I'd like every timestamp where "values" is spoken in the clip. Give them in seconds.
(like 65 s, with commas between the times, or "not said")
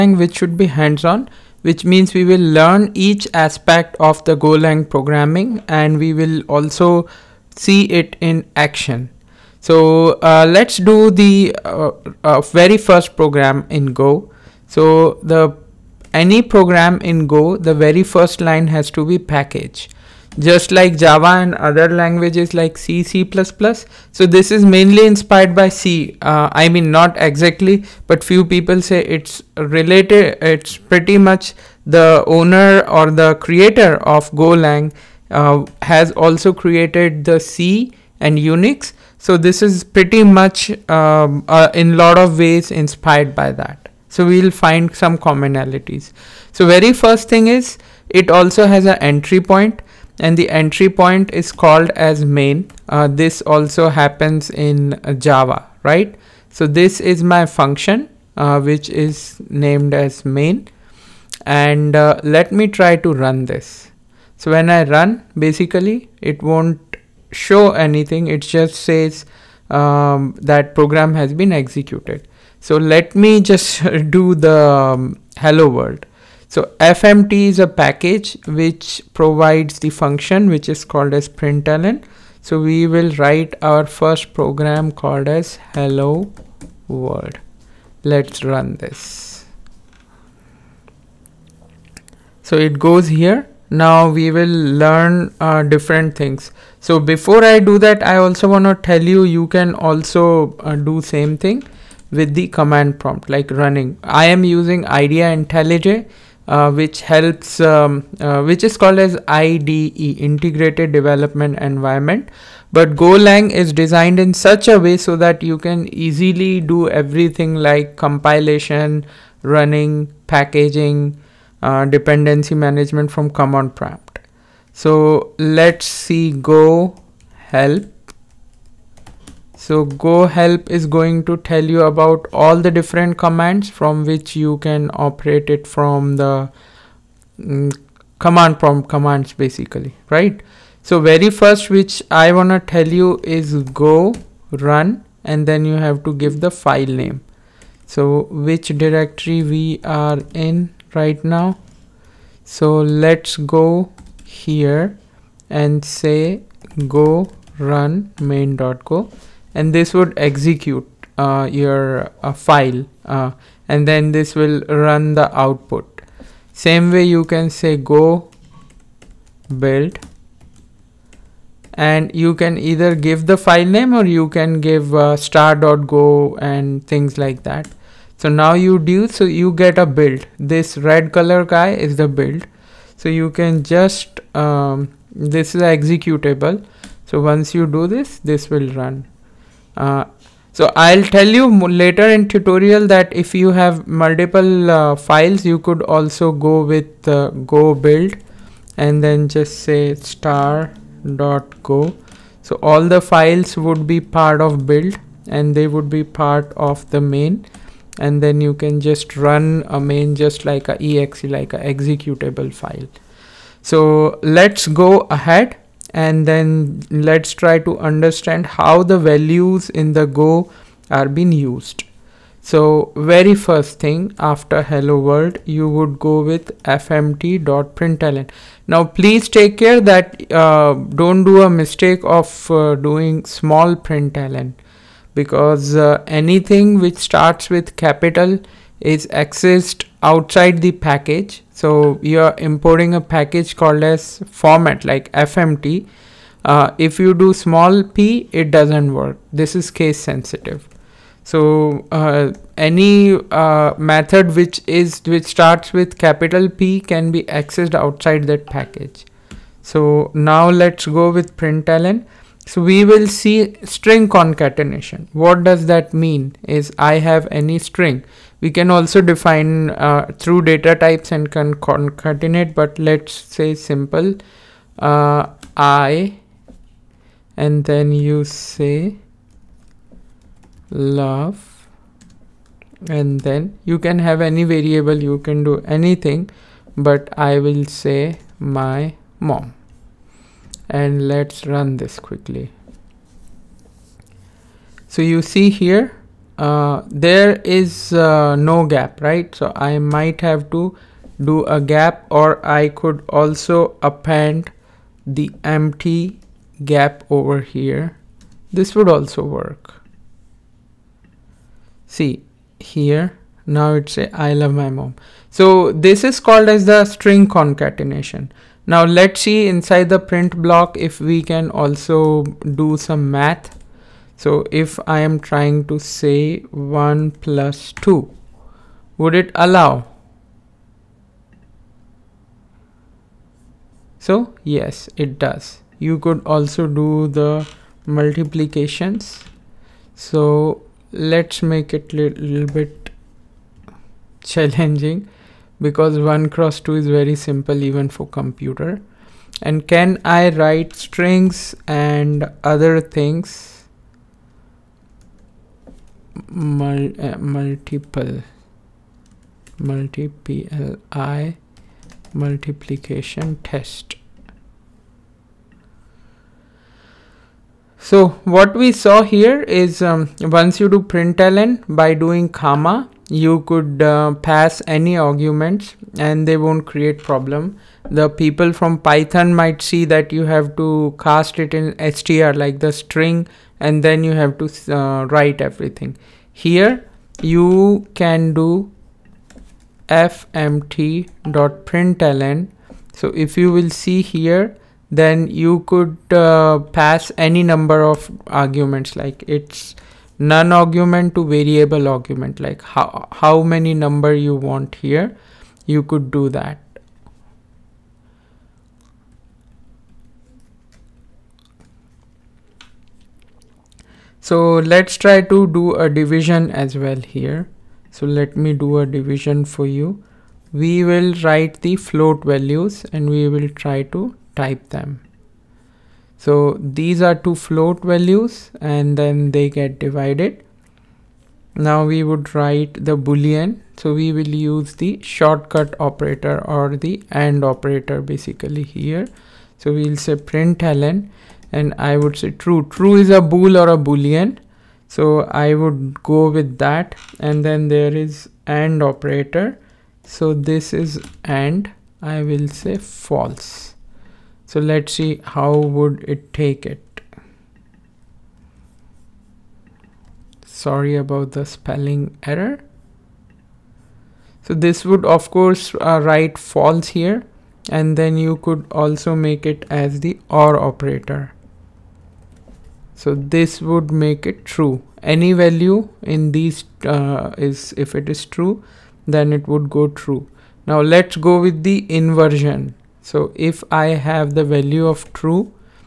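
219 s, 422 s, 427 s, 475 s, 484 s.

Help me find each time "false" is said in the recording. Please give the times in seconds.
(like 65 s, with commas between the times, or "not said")
452 s, 466 s.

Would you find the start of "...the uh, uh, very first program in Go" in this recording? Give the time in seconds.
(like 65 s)
11 s.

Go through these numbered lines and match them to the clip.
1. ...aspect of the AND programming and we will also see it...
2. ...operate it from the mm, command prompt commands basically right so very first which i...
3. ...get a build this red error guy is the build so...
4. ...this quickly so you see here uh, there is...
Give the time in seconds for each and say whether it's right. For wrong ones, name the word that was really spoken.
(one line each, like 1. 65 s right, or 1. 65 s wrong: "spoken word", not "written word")
1. 3 s wrong: "Golang", not "AND"
2. 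135 s right
3. 179 s wrong: "color", not "error"
4. 291 s right.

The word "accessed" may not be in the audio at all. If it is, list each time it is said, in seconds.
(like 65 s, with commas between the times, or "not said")
239 s, 257 s.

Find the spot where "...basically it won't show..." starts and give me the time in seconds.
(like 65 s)
65 s.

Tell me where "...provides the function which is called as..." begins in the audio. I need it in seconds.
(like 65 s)
79 s.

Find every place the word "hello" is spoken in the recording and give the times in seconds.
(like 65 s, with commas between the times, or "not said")
75 s, 85 s, 224 s.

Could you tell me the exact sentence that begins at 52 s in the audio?
Uh, this also happens in Java, right?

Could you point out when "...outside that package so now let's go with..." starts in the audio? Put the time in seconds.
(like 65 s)
257 s.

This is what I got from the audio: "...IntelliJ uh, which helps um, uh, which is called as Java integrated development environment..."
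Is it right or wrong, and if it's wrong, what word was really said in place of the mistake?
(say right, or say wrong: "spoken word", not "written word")
wrong: "IDE", not "Java".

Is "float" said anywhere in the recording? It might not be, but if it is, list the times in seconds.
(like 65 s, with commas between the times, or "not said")
421 s, 427 s.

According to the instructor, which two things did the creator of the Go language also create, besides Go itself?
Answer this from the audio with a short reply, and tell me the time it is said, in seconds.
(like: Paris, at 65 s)
C and Unix, at 37 s.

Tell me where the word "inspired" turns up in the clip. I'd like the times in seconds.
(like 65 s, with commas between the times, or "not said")
25 s, 42 s.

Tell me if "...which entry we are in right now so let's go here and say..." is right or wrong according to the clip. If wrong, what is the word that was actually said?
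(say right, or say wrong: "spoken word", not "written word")
wrong: "directory", not "entry".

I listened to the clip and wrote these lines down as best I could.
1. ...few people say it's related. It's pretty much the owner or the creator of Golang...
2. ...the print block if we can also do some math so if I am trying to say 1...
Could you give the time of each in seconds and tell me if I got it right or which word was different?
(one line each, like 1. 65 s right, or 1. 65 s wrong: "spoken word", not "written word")
1. 28 s right
2. 319 s right.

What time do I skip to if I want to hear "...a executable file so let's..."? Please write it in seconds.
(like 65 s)
211 s.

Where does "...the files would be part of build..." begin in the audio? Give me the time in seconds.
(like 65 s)
202 s.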